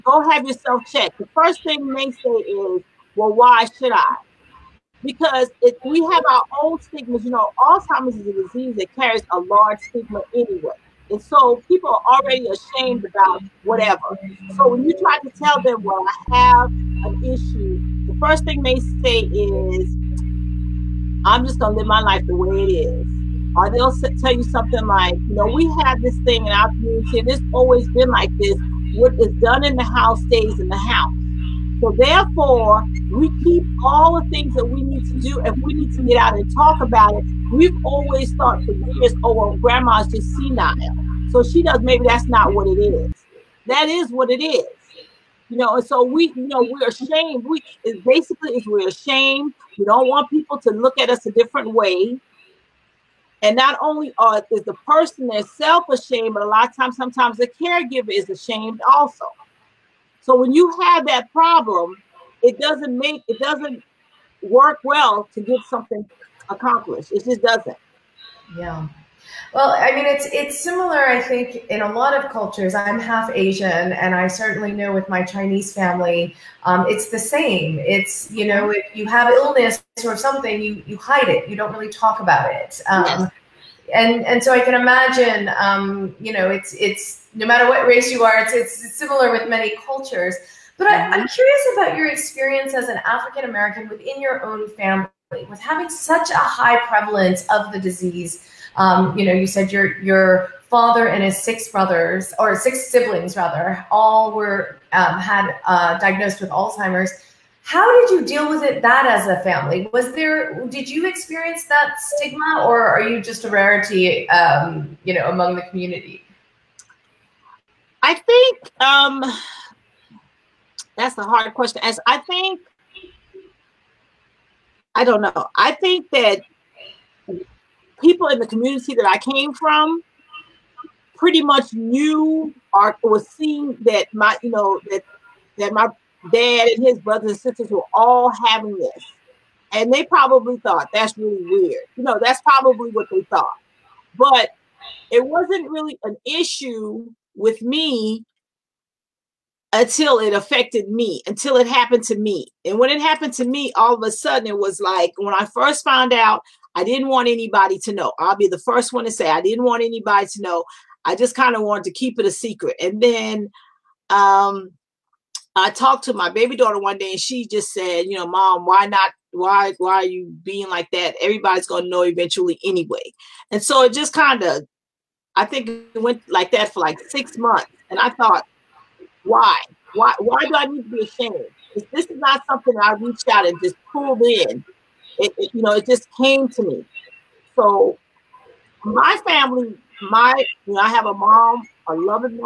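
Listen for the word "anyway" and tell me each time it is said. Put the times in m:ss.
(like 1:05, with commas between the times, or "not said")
0:10, 2:52.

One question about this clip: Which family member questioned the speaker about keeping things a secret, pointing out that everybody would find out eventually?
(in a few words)
baby daughter.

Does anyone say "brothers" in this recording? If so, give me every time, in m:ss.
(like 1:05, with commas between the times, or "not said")
1:41, 2:16.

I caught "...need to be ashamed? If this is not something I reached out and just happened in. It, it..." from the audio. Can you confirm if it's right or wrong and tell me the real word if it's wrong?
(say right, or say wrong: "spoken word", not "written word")
wrong: "pulled", not "happened".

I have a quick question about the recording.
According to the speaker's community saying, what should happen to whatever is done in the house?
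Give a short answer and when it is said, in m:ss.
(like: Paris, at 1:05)
stays in the house, at 0:30.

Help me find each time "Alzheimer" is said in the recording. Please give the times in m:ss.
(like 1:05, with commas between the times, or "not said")
0:07, 1:46.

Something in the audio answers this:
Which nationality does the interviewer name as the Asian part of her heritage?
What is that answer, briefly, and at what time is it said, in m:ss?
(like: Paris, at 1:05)
Chinese, at 1:15.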